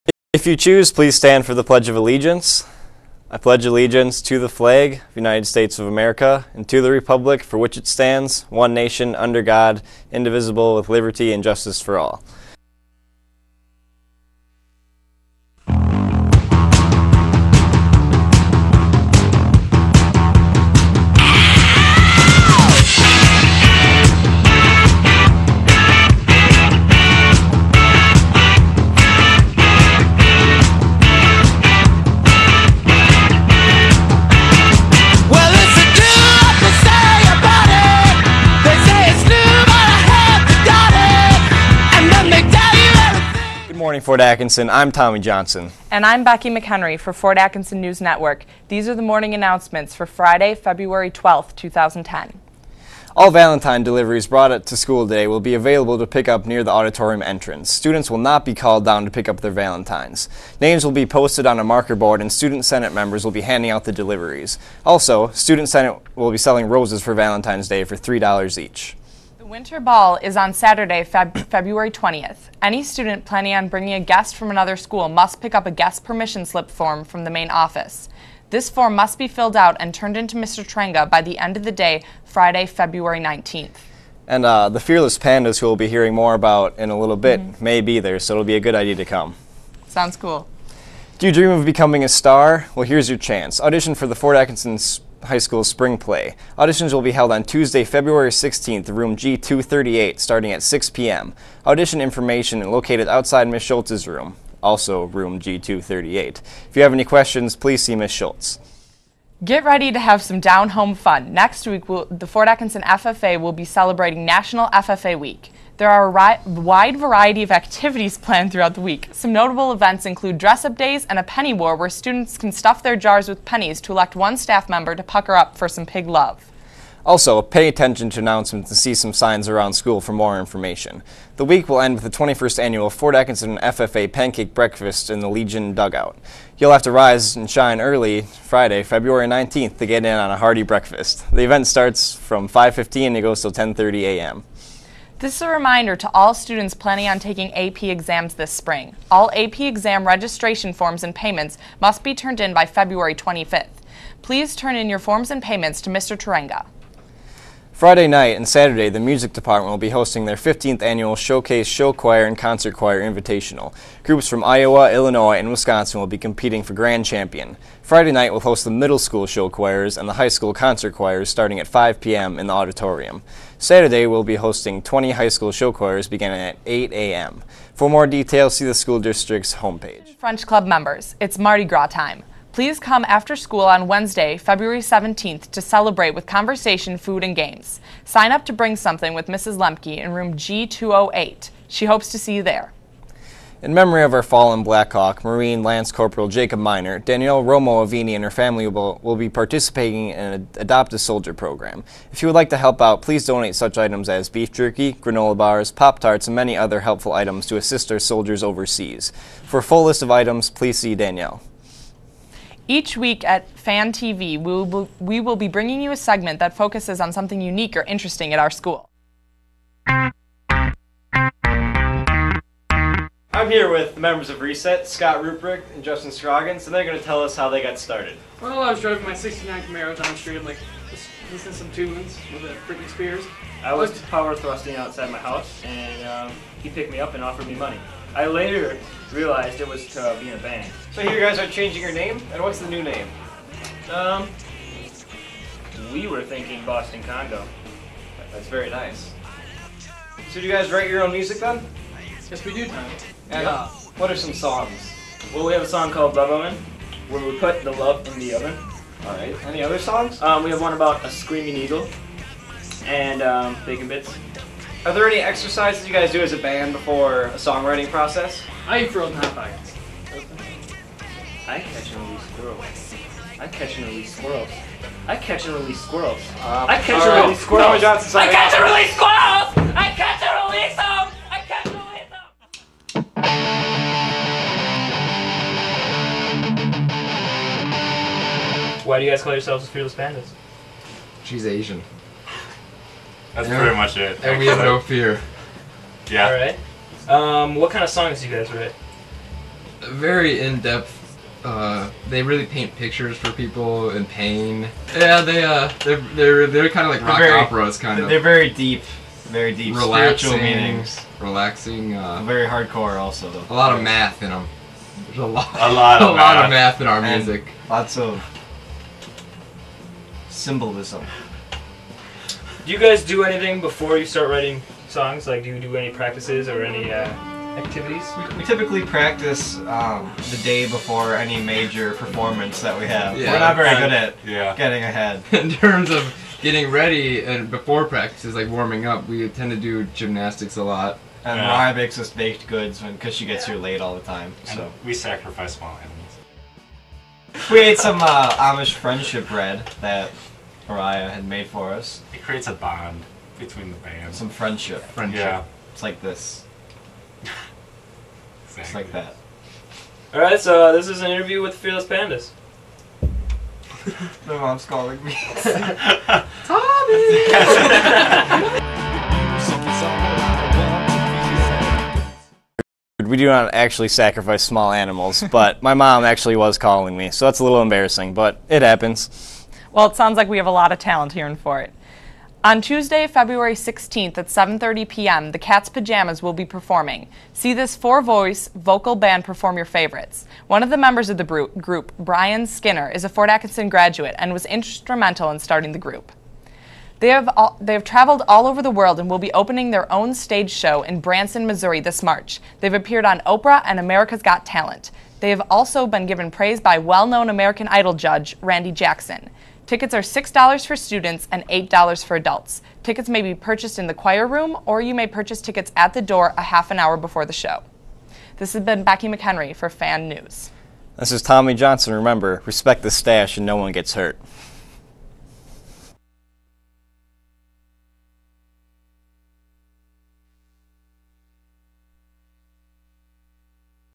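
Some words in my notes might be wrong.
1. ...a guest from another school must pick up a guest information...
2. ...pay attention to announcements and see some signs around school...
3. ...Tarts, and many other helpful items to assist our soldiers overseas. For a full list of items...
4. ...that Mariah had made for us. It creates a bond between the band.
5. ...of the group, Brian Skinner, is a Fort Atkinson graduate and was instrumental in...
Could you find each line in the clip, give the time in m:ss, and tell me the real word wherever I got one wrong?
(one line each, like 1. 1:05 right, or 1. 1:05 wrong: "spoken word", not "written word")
1. 1:13 wrong: "permission", not "information"
2. 2:07 right
3. 3:25 right
4. 5:49 right
5. 6:31 right.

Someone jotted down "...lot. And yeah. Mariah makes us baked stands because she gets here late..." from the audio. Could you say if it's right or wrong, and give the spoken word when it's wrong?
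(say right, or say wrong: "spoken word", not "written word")
wrong: "goods", not "stands".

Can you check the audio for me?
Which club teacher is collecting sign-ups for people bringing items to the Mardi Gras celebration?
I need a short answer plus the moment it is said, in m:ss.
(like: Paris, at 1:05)
Mrs. Lemke, at 3:09.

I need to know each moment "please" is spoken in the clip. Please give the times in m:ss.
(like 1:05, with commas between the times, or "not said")
0:00, 1:47, 2:34, 3:02, 3:23, 3:30.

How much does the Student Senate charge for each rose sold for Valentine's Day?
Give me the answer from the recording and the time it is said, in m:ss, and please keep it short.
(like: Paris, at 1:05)
$3, at 1:07.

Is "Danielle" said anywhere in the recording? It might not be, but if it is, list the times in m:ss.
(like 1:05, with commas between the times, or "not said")
3:16, 3:30.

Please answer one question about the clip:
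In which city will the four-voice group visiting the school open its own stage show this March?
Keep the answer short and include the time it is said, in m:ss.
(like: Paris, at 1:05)
Branson, Missouri, at 6:40.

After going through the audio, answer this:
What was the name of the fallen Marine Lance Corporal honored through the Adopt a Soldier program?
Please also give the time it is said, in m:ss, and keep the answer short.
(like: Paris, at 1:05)
Jacob Miner, at 3:16.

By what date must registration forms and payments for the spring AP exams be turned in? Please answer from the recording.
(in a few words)
February 25th.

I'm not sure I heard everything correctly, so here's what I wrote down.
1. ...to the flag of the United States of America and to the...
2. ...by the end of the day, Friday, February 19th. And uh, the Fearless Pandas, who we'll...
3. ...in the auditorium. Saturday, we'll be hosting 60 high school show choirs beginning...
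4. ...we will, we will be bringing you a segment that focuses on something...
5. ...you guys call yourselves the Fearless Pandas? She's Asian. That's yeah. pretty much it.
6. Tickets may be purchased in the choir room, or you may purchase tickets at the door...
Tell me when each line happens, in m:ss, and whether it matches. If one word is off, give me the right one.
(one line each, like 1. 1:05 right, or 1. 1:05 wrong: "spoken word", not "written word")
1. 0:04 right
2. 1:21 right
3. 2:52 wrong: "20", not "60"
4. 3:34 right
5. 4:49 right
6. 6:52 right.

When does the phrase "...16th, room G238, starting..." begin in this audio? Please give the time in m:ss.
1:38.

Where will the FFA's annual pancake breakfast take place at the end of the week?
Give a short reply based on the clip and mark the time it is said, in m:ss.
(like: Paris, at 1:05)
Legion Dugout, at 2:15.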